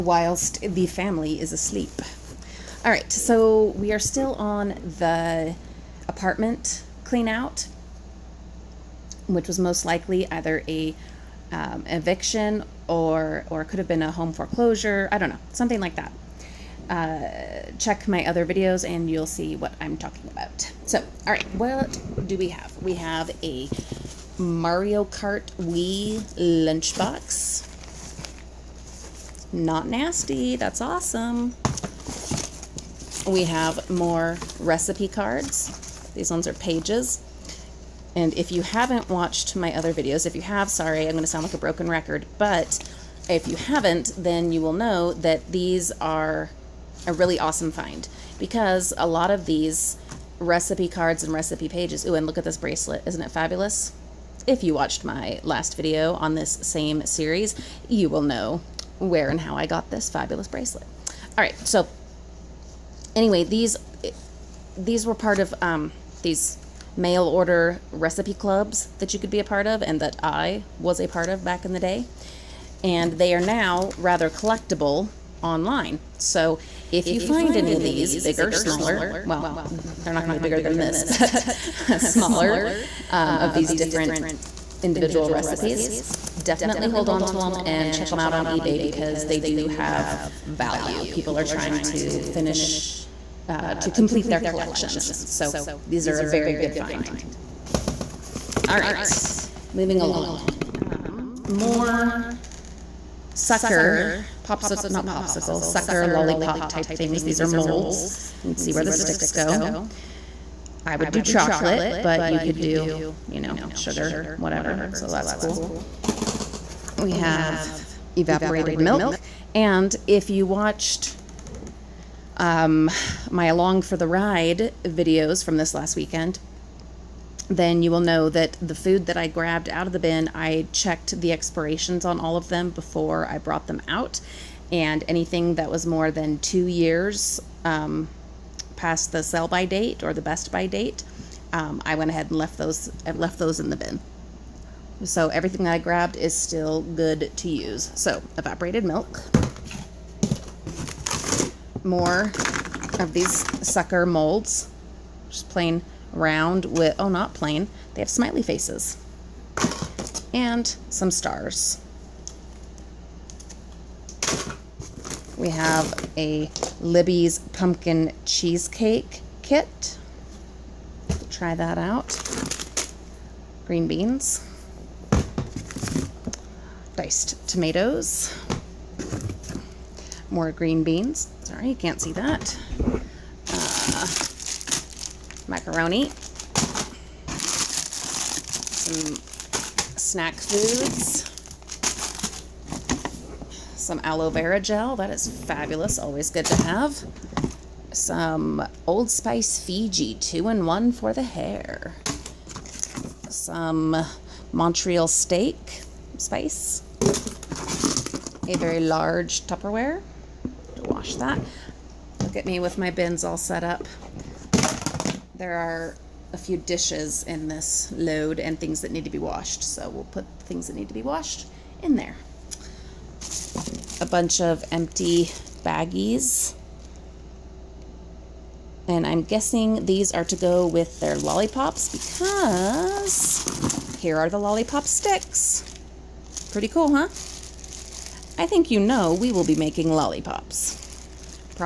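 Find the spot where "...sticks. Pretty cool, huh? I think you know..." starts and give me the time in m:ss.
3:54.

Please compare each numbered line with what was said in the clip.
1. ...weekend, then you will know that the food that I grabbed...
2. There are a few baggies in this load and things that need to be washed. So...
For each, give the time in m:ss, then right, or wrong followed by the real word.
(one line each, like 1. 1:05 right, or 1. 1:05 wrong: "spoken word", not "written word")
1. 2:05 right
2. 3:35 wrong: "dishes", not "baggies".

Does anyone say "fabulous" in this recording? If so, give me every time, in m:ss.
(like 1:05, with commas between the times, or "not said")
0:53, 1:00, 3:15.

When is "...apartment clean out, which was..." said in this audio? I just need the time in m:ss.
0:06.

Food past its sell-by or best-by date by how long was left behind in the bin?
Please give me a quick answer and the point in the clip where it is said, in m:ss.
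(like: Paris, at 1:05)
2 years, at 2:16.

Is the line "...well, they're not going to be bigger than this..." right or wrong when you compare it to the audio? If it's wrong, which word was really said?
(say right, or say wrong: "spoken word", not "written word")
right.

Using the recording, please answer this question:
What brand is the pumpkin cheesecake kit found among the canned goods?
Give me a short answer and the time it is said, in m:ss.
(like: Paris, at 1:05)
Libby's, at 2:46.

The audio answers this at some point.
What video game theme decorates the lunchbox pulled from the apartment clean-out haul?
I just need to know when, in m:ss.
0:24.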